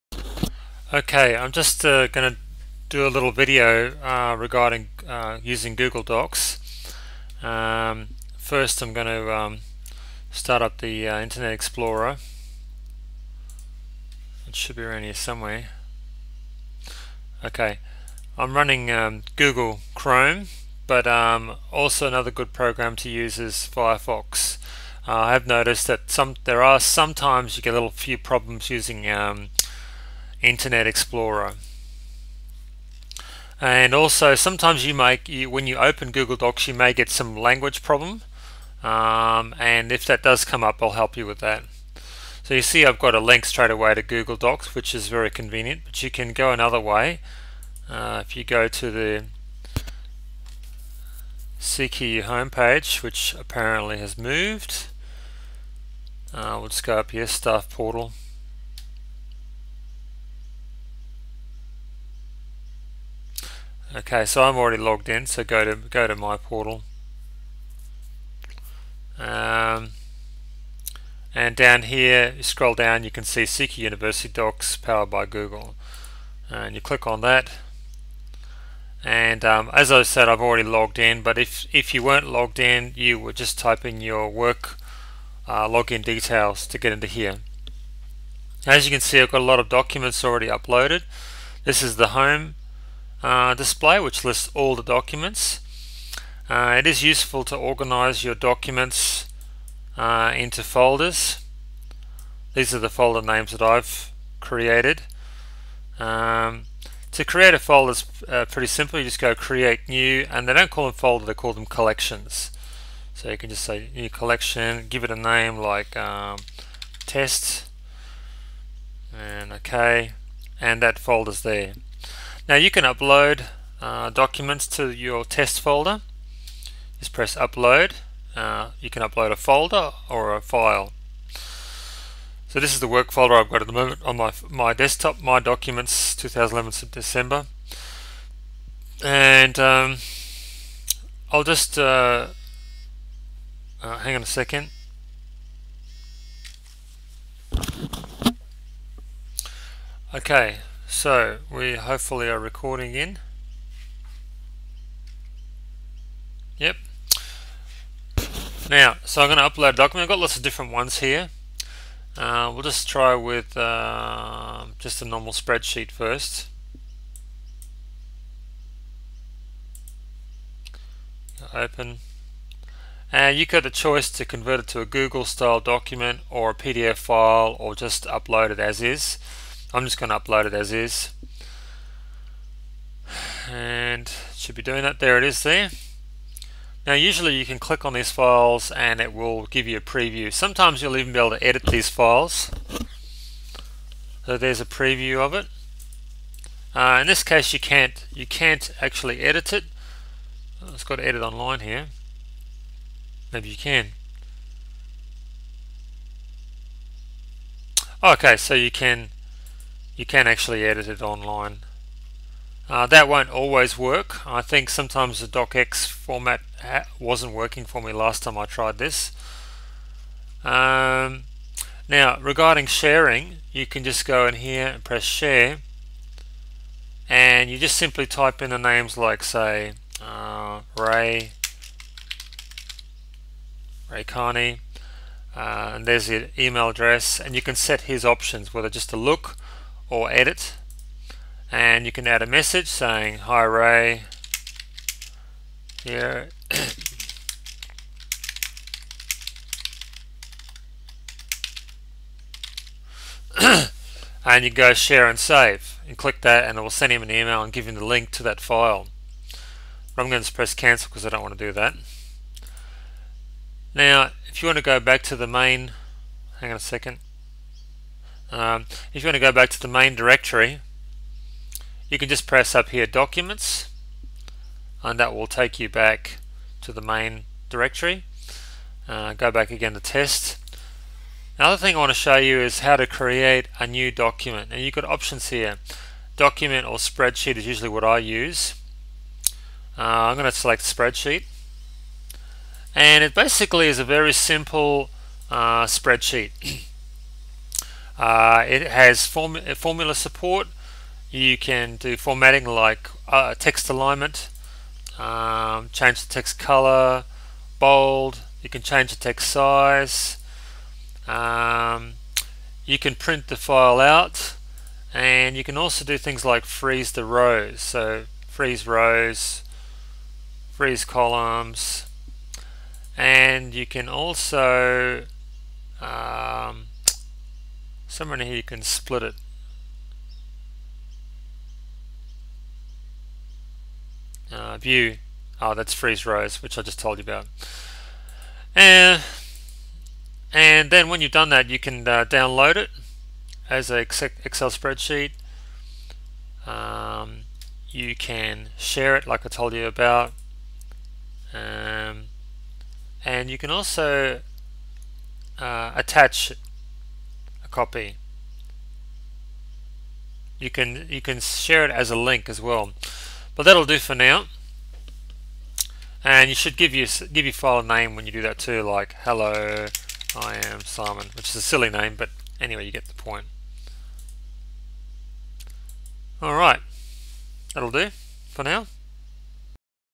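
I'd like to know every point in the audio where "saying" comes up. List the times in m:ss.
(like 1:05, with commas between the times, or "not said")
4:02.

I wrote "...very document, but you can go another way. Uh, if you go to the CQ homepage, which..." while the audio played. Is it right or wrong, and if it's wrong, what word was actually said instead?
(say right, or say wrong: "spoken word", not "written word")
wrong: "convenient", not "document".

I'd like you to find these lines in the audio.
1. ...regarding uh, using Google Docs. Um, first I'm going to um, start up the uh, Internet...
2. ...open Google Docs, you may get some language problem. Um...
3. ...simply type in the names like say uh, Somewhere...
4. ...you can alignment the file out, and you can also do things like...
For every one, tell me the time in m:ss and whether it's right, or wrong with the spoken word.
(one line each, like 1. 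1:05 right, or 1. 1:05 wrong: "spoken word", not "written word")
1. 0:04 right
2. 0:35 right
3. 3:47 wrong: "Ray", not "Somewhere"
4. 5:12 wrong: "print", not "alignment".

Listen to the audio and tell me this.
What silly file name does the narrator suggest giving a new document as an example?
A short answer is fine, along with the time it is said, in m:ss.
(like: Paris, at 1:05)
hello, I am Simon, at 6:09.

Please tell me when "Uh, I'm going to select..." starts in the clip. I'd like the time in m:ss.
4:49.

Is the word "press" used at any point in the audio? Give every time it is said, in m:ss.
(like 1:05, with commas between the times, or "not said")
2:07, 3:44, 4:20, 4:32.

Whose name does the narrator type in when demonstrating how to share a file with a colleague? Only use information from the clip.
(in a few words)
Ray Carney.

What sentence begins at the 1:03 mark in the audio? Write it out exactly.
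Okay, so I'm already logged in, so go to go to my portal.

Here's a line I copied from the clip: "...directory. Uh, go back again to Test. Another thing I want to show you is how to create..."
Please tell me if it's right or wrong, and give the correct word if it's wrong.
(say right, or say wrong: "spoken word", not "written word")
right.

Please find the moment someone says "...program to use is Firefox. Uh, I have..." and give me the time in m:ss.
0:22.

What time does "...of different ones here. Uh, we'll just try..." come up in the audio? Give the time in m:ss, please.
2:40.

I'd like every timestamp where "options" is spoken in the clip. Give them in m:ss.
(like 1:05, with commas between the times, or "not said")
3:58, 4:44.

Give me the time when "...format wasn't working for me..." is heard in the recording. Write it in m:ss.
3:35.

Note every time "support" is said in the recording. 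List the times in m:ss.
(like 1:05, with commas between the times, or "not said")
4:59.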